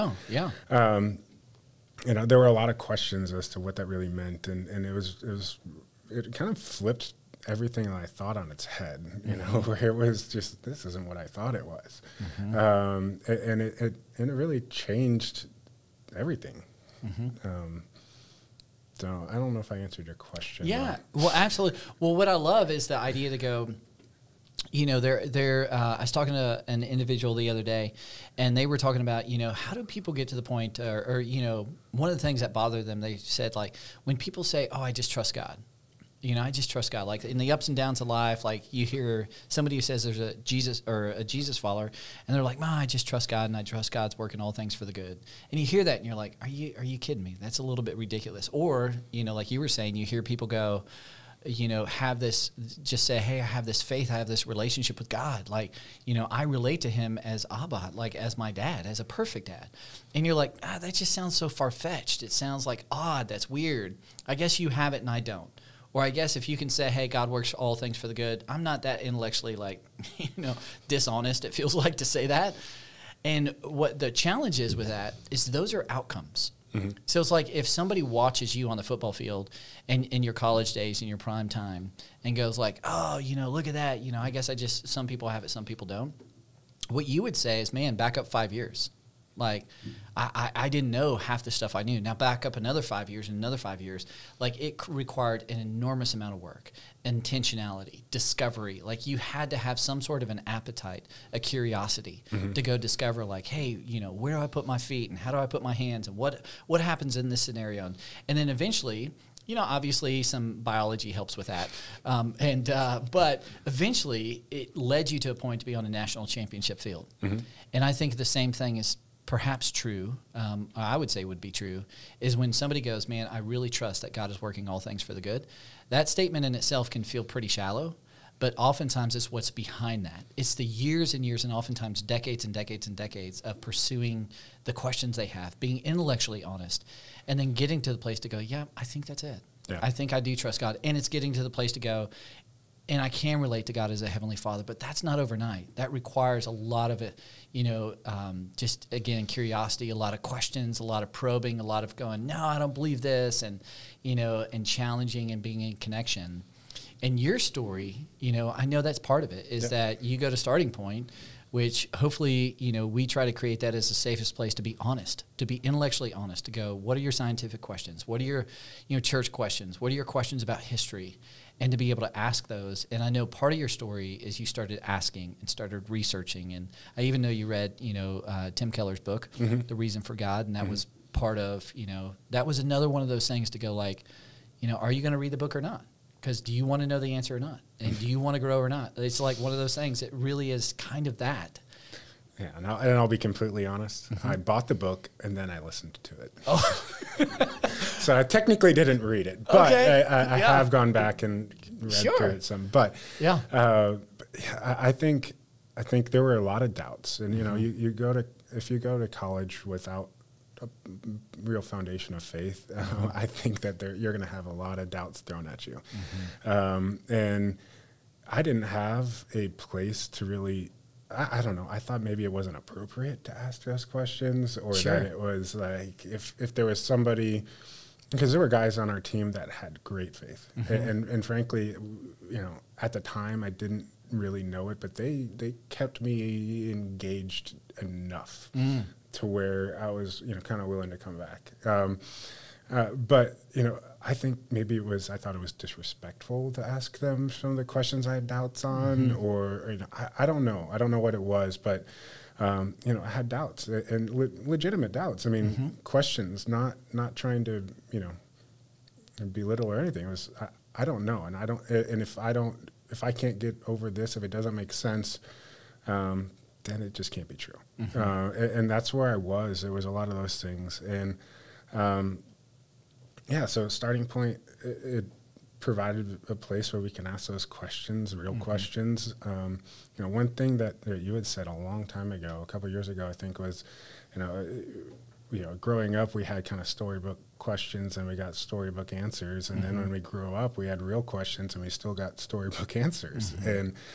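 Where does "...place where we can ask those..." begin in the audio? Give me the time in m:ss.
4:36.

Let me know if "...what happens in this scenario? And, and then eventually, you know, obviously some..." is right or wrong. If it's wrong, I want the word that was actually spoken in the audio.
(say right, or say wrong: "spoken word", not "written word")
right.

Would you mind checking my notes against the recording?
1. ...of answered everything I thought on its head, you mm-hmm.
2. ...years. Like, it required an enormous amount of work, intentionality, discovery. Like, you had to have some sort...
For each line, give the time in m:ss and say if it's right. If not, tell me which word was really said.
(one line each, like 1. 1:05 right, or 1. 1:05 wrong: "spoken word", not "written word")
1. 0:06 wrong: "flipped", not "answered"
2. 1:33 right.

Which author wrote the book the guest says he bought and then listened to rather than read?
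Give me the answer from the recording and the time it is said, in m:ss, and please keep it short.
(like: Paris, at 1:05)
Tim Keller, at 2:58.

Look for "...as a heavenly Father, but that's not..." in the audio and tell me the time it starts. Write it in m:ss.
2:23.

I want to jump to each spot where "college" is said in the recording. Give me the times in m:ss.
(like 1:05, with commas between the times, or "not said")
1:20, 3:29.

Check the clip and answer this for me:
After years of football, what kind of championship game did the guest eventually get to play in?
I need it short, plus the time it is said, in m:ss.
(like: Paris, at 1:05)
national championship, at 1:55.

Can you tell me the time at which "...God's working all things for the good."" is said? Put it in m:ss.
0:43.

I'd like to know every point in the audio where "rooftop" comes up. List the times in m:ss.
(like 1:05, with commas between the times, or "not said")
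not said.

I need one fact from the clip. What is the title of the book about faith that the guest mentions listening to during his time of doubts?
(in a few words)
The Reason for God.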